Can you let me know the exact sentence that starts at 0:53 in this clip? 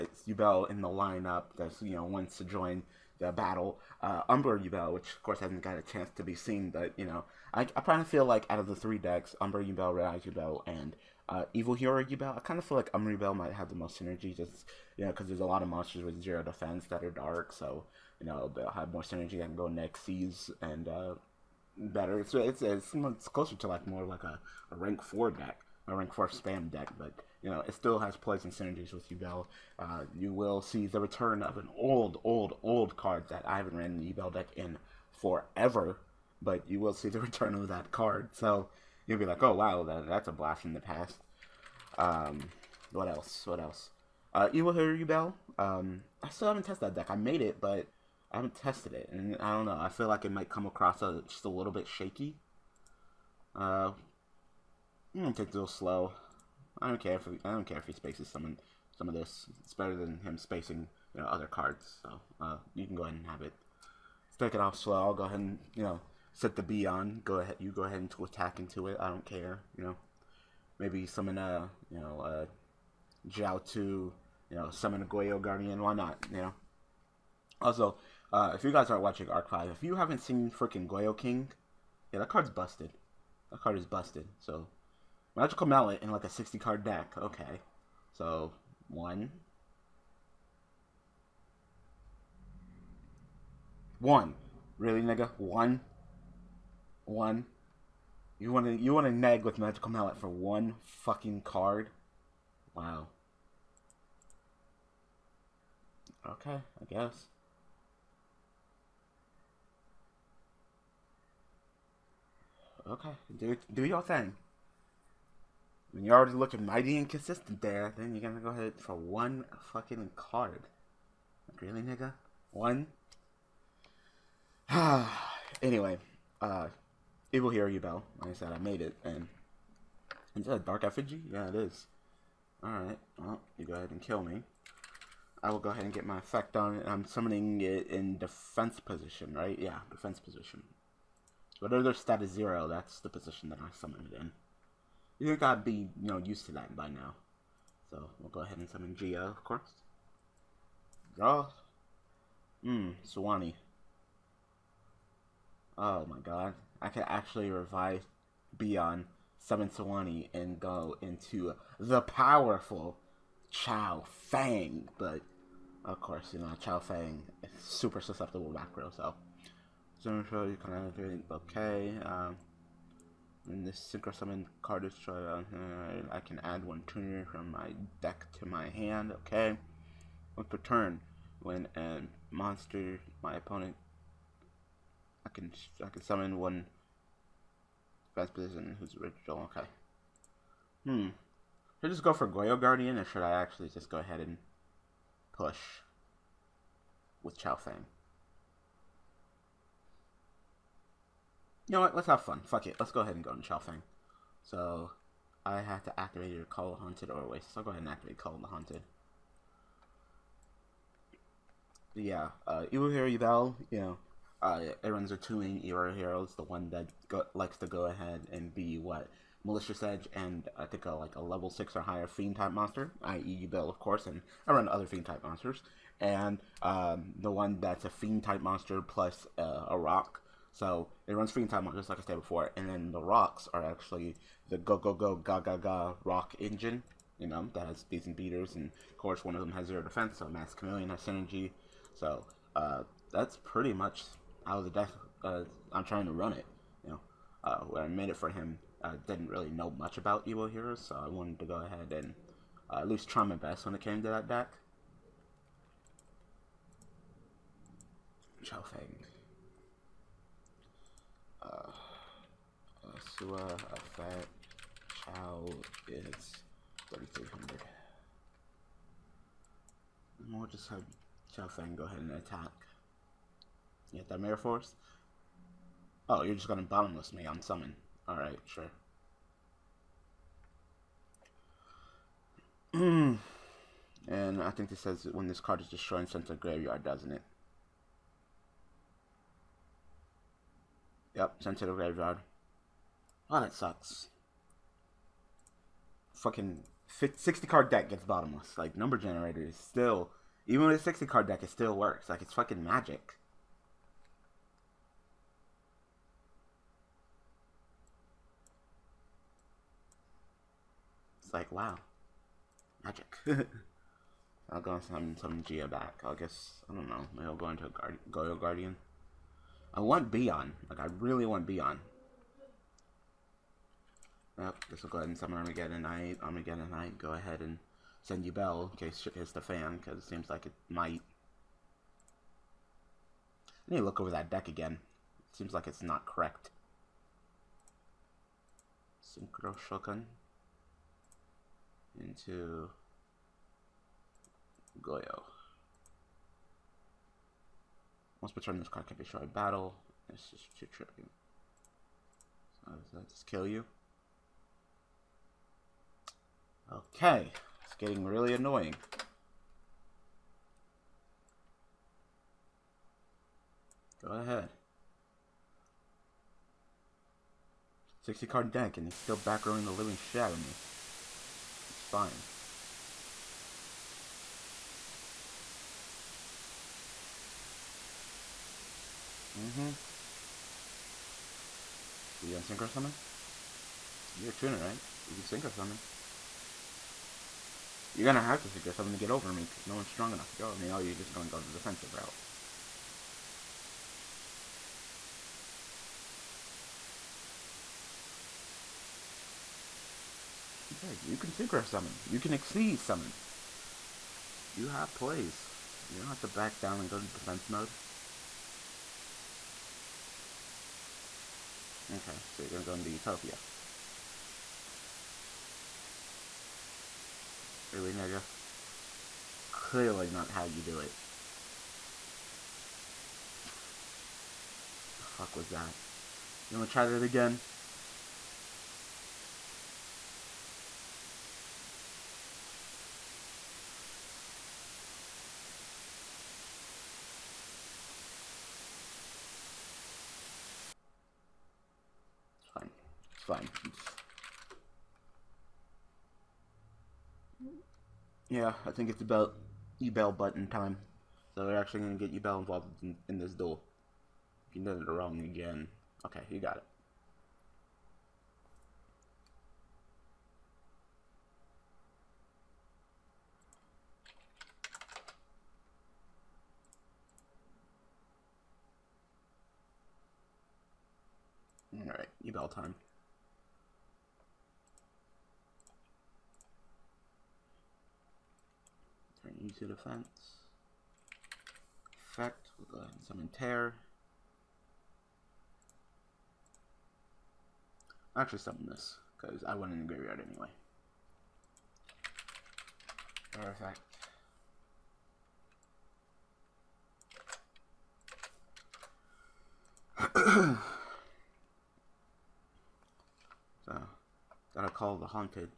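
Uh, I'm gonna take it a little slow.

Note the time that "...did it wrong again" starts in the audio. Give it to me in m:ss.
7:34.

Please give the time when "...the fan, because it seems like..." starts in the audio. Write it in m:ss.
5:29.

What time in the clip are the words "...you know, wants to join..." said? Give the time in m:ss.
0:01.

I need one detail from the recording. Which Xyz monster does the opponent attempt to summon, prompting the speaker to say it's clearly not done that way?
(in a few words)
Utopia.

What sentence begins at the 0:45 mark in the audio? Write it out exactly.
Um, I still haven't tested that deck.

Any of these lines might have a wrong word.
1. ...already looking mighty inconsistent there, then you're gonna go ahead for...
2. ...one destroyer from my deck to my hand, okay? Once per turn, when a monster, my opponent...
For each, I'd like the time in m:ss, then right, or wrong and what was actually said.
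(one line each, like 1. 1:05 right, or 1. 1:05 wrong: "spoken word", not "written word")
1. 1:56 right
2. 2:56 wrong: "tuner", not "destroyer".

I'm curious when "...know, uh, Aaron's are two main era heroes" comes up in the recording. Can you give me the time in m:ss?
3:33.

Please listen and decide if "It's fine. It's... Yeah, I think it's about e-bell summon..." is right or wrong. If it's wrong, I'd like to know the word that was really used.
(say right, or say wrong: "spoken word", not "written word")
wrong: "button", not "summon".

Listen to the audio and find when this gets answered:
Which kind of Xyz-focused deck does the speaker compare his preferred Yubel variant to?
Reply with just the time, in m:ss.
0:25.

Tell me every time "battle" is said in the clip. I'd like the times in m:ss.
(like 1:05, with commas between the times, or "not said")
0:03, 5:49.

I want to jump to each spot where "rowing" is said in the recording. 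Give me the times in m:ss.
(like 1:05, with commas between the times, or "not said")
6:09.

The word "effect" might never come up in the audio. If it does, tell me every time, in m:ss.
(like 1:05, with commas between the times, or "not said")
2:16, 8:02.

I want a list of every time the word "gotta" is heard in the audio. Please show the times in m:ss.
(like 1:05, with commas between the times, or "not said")
2:25, 8:24.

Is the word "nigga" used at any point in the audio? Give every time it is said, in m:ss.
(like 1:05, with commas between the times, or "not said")
1:35, 2:01, 6:57.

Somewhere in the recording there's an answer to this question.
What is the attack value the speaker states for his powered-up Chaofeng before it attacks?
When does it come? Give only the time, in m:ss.
4:26.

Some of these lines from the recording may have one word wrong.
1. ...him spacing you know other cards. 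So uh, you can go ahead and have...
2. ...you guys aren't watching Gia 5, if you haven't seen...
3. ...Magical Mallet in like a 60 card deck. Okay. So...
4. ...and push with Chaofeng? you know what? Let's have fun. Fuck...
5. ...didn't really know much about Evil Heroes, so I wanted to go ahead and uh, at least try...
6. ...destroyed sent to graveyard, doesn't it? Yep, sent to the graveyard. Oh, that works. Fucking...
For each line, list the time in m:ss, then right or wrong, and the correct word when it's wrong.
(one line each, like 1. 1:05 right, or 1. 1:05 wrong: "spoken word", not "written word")
1. 1:00 right
2. 1:18 wrong: "Arc", not "Gia"
3. 1:25 right
4. 3:14 right
5. 4:09 right
6. 4:45 wrong: "sucks", not "works".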